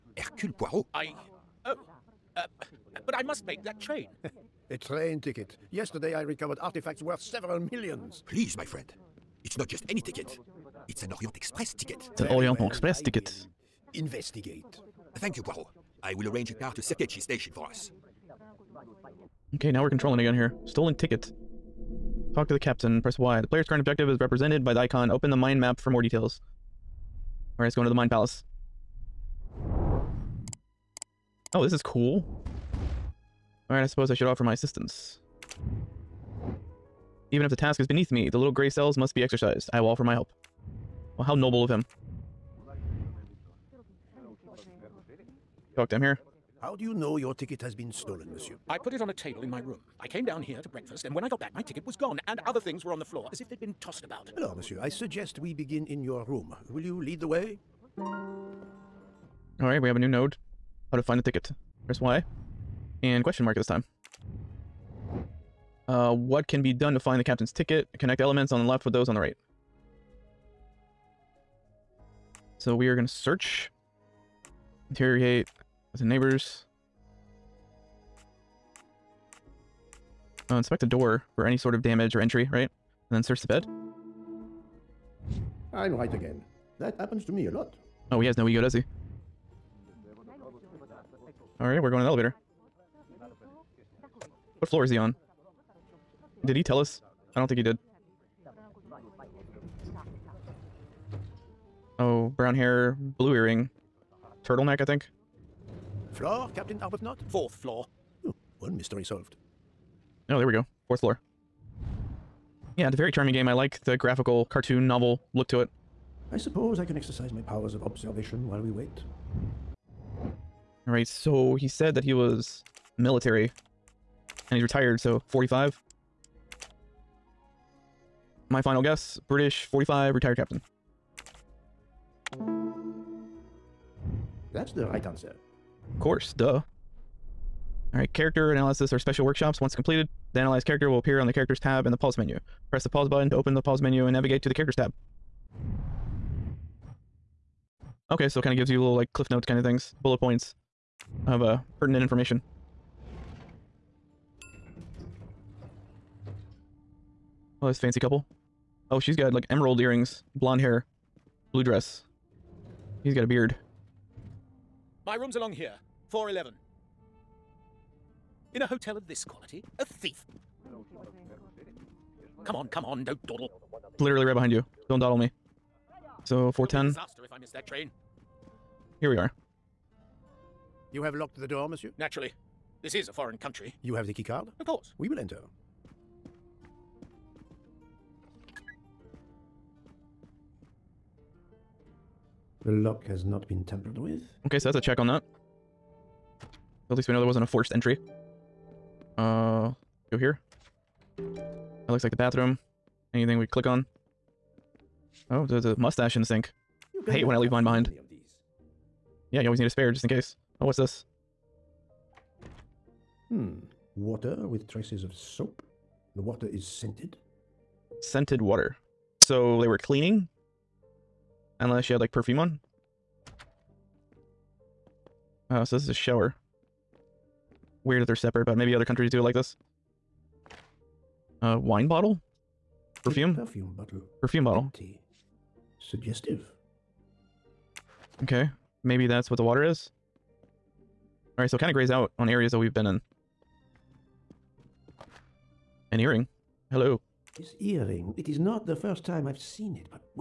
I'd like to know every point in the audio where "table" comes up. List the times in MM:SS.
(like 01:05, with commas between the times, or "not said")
00:49.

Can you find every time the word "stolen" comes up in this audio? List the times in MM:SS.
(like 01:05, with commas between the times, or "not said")
00:20, 00:47.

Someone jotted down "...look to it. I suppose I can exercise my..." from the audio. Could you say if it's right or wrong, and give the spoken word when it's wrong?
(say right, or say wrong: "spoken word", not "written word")
right.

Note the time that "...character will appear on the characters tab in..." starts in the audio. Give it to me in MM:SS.
02:20.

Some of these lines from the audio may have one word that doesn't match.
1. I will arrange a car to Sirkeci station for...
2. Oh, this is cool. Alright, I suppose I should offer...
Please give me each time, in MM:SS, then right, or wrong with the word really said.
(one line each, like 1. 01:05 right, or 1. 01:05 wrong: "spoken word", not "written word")
1. 00:16 right
2. 00:31 right.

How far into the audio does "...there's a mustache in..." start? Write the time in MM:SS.
03:25.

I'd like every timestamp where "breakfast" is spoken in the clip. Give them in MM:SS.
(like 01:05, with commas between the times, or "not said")
00:50.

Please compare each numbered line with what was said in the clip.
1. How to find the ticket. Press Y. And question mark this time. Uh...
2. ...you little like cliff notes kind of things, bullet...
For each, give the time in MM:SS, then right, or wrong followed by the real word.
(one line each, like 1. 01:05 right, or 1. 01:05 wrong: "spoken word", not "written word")
1. 01:00 right
2. 02:28 right.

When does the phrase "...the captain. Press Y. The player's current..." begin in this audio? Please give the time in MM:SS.
00:22.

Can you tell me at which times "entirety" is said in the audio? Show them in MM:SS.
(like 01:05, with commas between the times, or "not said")
not said.